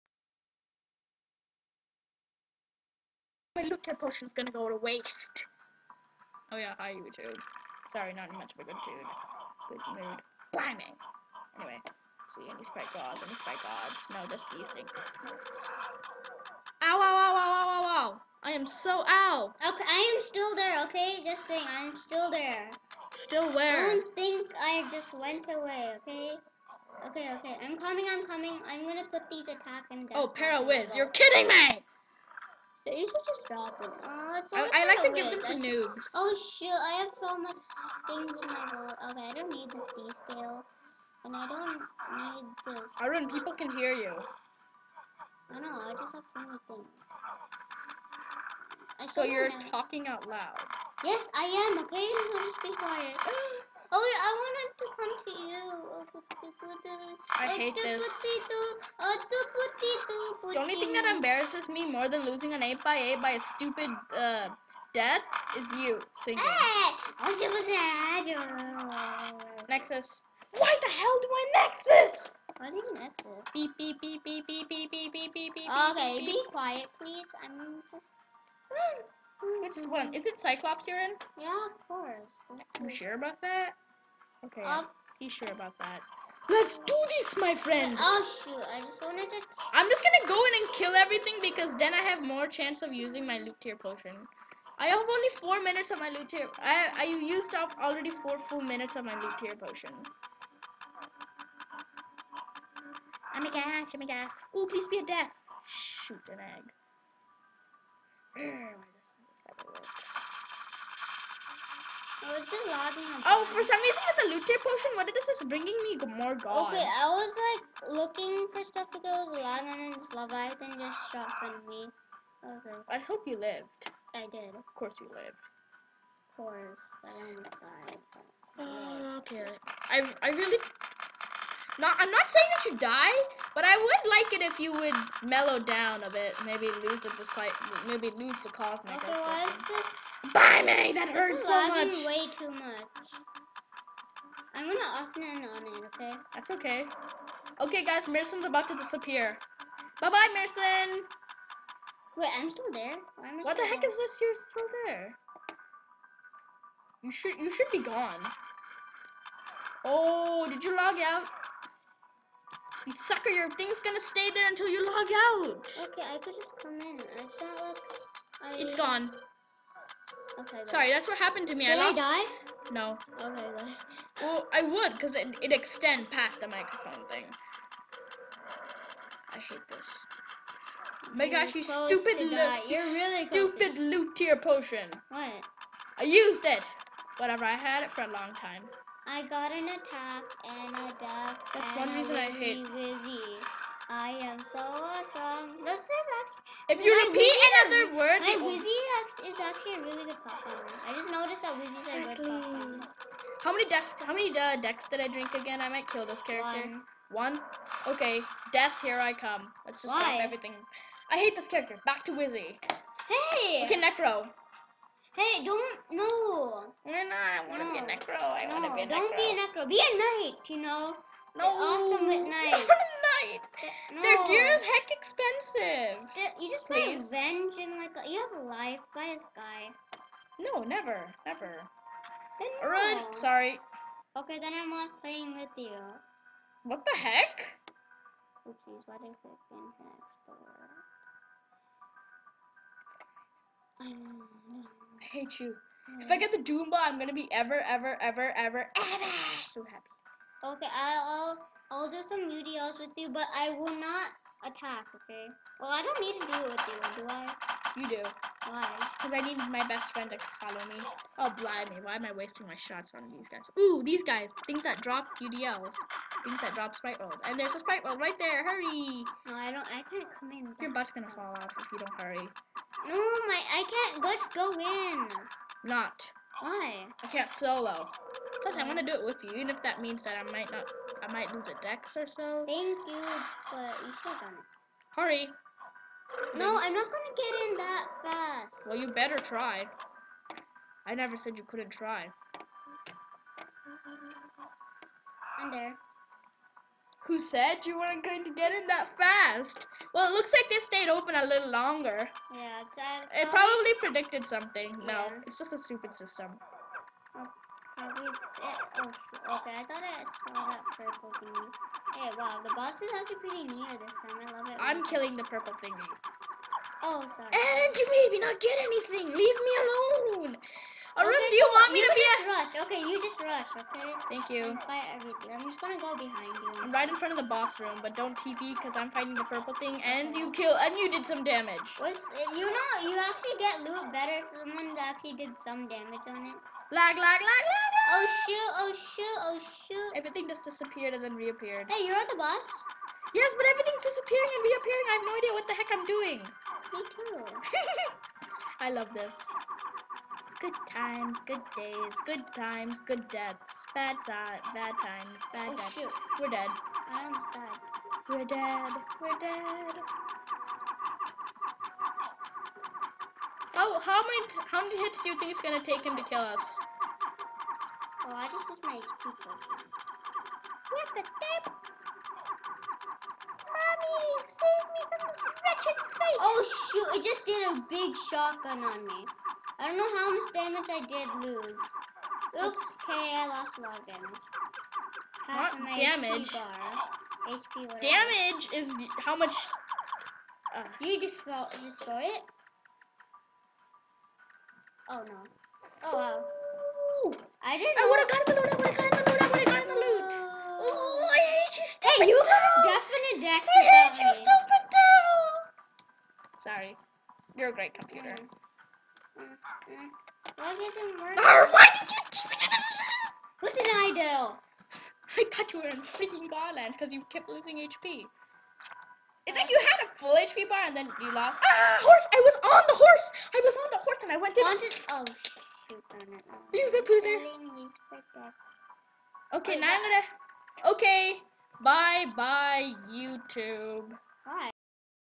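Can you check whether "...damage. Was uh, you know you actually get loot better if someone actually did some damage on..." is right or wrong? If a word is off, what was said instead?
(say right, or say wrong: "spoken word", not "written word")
right.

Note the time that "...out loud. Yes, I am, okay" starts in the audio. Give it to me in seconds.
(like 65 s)
50 s.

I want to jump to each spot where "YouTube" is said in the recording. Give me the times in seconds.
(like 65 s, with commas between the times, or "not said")
6 s, 432 s.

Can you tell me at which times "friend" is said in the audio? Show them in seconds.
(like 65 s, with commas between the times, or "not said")
87 s, 259 s.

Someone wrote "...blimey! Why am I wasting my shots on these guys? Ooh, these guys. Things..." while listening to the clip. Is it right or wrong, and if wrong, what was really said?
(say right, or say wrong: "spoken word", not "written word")
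right.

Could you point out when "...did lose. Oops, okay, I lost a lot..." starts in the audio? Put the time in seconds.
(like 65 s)
380 s.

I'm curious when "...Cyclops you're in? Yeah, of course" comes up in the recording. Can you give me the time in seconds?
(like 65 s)
80 s.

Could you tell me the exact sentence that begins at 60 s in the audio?
The only thing that embarrasses me more than losing an 8 by 8 by a stupid uh, death is you singing.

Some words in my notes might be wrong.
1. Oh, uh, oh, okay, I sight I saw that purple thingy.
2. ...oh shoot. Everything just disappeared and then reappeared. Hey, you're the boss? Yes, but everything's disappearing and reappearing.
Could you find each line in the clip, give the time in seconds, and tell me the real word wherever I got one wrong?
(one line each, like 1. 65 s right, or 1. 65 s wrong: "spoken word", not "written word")
1. 307 s wrong: "thought", not "sight"
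2. 339 s right.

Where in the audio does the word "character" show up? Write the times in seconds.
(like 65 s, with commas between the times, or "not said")
206 s, 211 s.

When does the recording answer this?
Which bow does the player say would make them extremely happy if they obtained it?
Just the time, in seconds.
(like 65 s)
246 s.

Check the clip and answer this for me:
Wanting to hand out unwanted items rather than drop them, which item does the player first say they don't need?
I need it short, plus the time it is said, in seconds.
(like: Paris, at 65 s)
Sea scale, at 39 s.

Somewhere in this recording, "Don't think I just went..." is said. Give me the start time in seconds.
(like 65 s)
23 s.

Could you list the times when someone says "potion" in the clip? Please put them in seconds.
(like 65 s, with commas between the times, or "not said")
3 s, 93 s, 99 s, 114 s, 184 s.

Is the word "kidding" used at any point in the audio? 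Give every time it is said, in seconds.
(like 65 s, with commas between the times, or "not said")
31 s.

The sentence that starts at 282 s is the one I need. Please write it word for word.
Thank you, but you should have done it.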